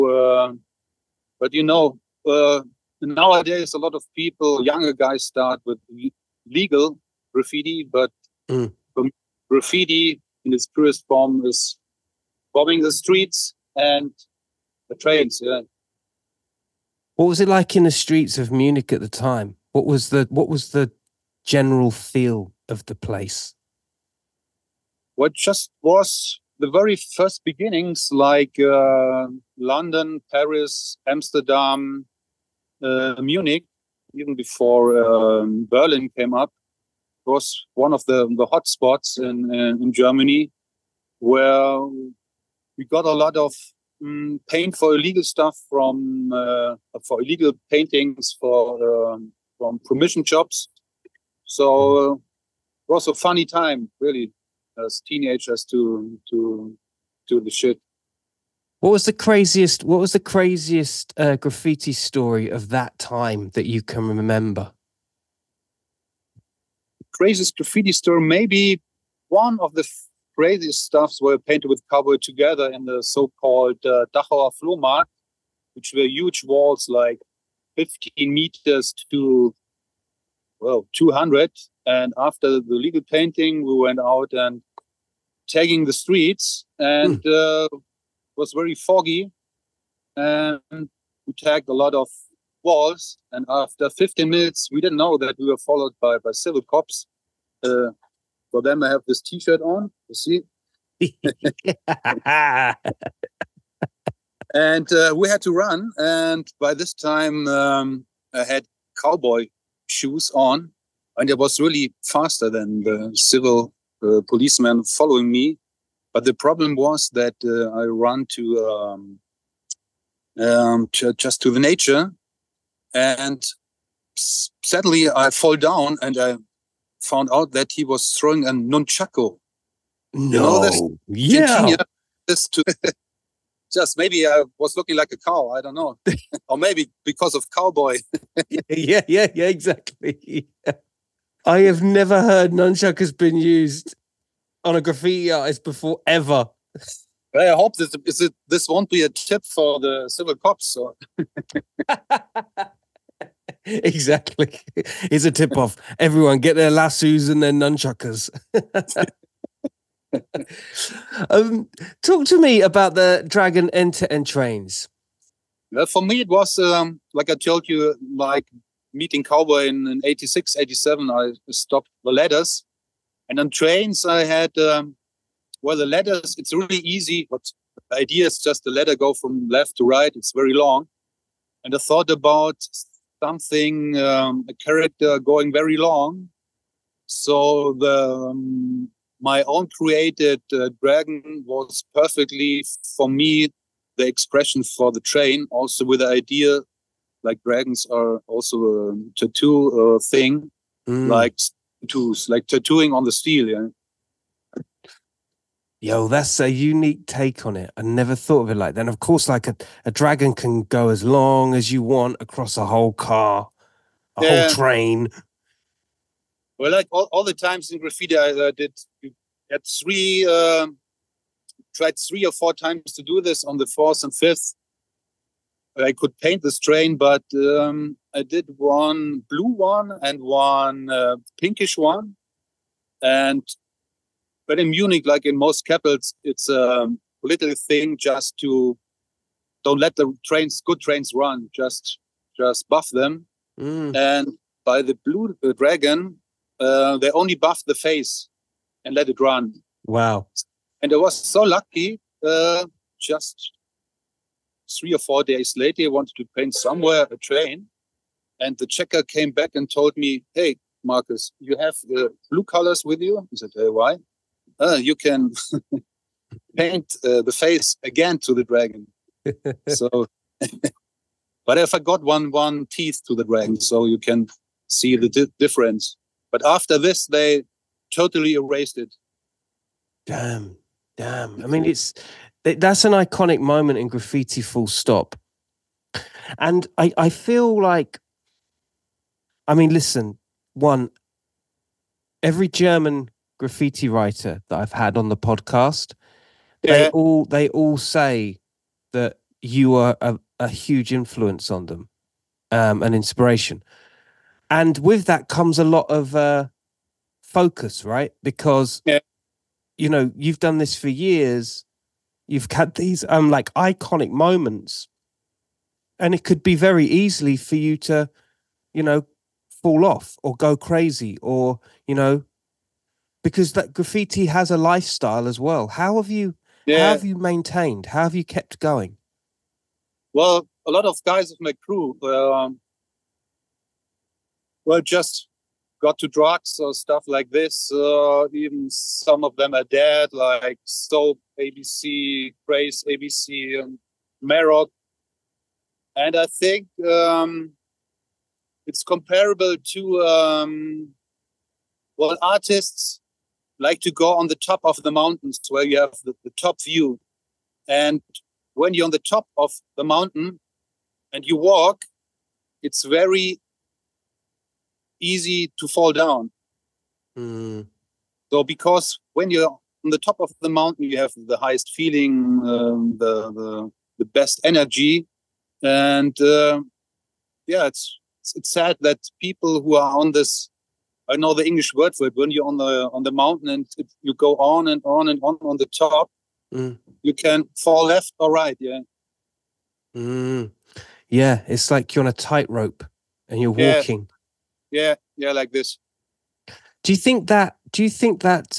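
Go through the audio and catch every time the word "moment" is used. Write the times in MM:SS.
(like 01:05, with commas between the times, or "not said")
04:43, 05:14.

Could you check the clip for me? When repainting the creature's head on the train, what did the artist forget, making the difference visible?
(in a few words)
one teeth.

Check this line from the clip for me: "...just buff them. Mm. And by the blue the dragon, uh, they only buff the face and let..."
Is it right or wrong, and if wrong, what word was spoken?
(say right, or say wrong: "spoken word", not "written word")
right.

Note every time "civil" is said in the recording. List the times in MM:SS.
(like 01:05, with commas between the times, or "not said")
01:36, 01:53, 02:30.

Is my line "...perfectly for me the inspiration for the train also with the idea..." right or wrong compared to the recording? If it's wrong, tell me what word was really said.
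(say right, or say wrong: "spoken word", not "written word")
wrong: "expression", not "inspiration".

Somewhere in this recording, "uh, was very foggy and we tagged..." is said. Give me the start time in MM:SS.
01:27.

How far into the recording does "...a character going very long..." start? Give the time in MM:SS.
03:04.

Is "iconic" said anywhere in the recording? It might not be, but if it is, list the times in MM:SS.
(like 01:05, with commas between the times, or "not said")
04:42, 05:13.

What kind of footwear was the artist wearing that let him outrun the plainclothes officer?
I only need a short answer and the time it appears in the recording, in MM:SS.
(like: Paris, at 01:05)
cowboy shoes, at 01:49.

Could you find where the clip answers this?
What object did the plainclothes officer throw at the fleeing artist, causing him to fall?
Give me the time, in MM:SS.
02:08.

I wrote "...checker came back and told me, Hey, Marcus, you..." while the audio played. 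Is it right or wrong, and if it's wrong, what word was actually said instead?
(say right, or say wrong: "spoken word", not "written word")
right.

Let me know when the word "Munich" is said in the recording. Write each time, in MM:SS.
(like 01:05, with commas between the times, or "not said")
00:18, 00:33, 03:54.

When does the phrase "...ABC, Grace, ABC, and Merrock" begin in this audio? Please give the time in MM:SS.
05:41.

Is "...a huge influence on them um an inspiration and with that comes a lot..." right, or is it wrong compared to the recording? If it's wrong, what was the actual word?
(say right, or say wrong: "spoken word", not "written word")
right.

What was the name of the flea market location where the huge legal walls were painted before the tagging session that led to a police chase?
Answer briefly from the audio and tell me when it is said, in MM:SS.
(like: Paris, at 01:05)
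Dachauer Flohmarkt, at 01:14.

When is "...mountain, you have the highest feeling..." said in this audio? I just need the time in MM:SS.
06:10.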